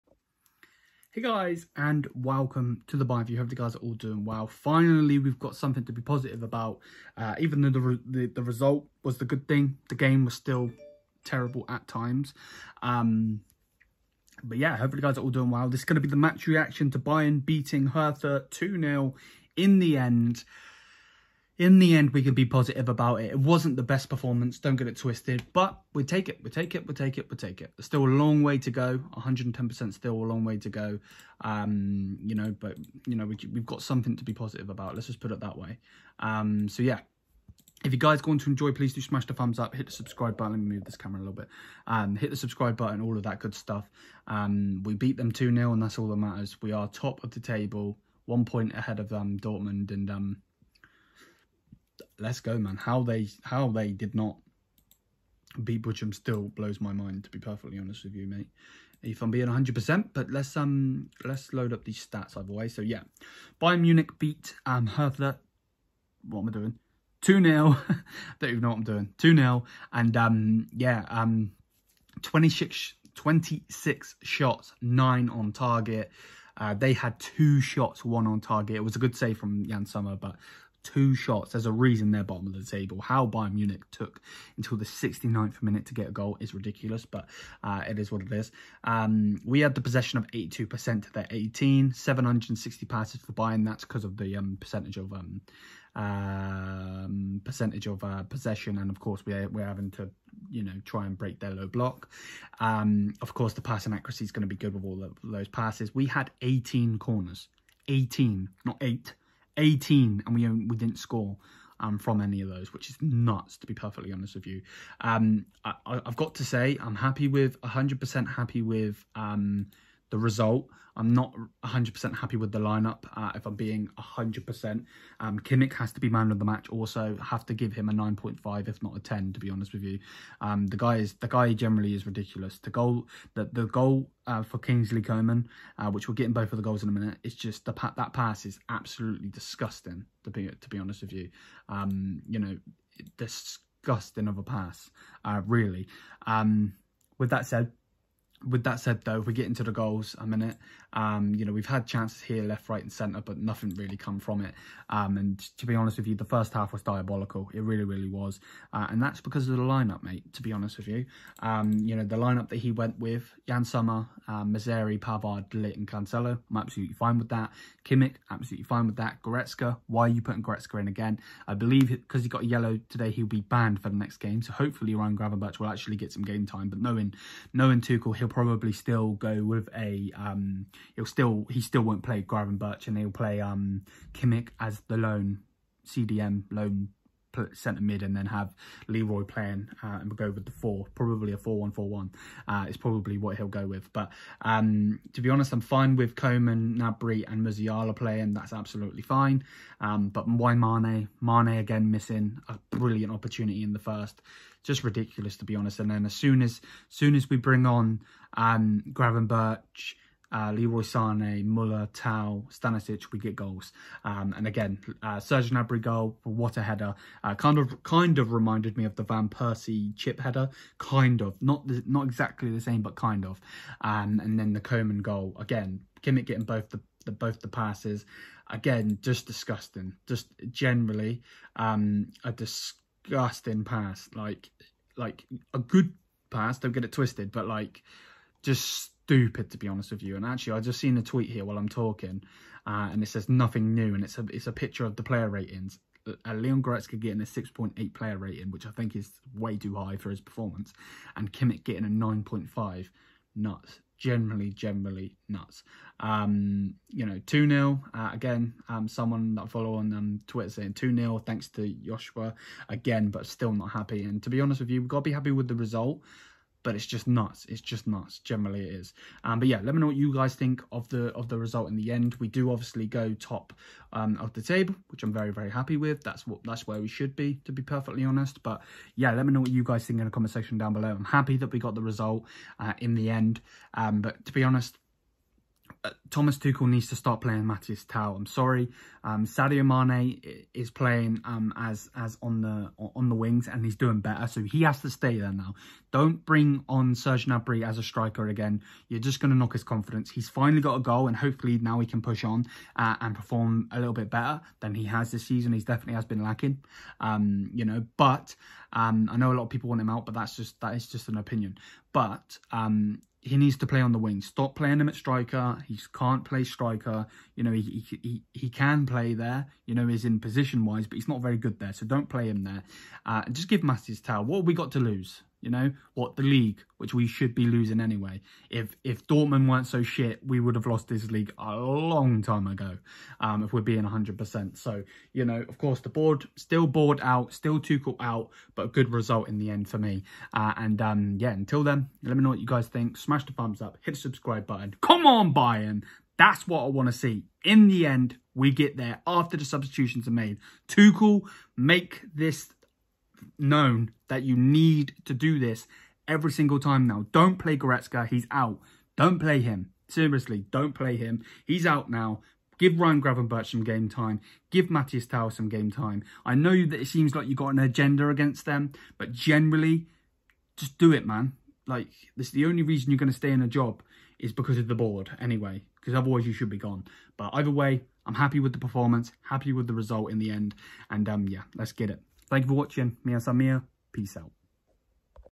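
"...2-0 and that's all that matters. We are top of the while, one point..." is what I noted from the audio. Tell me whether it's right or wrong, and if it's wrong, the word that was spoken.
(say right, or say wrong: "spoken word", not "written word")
wrong: "table", not "while".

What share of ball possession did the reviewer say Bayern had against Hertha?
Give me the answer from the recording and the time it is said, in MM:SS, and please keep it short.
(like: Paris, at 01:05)
82%, at 01:30.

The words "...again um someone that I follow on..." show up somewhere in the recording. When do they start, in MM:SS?
04:18.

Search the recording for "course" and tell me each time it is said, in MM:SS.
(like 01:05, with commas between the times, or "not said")
01:39, 01:43, 05:35.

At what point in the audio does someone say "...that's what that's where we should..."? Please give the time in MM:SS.
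04:36.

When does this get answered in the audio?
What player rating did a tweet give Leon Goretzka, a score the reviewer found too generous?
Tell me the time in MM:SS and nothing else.
04:07.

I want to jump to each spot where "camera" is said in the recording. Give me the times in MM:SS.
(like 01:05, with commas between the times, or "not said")
00:40.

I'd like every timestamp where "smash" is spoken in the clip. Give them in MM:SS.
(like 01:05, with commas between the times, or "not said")
00:39, 05:42.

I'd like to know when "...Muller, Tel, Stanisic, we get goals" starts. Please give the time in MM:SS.
03:31.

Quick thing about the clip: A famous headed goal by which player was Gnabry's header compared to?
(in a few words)
Van Persie.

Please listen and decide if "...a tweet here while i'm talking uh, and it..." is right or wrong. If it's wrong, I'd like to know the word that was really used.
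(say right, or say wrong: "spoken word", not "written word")
right.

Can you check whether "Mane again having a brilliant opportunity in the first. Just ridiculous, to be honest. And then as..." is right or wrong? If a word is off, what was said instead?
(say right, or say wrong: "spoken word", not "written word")
wrong: "missing", not "having".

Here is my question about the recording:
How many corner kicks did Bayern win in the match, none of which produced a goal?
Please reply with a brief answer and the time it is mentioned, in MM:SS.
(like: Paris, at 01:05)
18, at 01:46.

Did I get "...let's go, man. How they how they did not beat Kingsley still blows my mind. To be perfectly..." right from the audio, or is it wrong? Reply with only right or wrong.
wrong.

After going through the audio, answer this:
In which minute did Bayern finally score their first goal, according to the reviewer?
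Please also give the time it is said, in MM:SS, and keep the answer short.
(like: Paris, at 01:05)
69th, at 01:24.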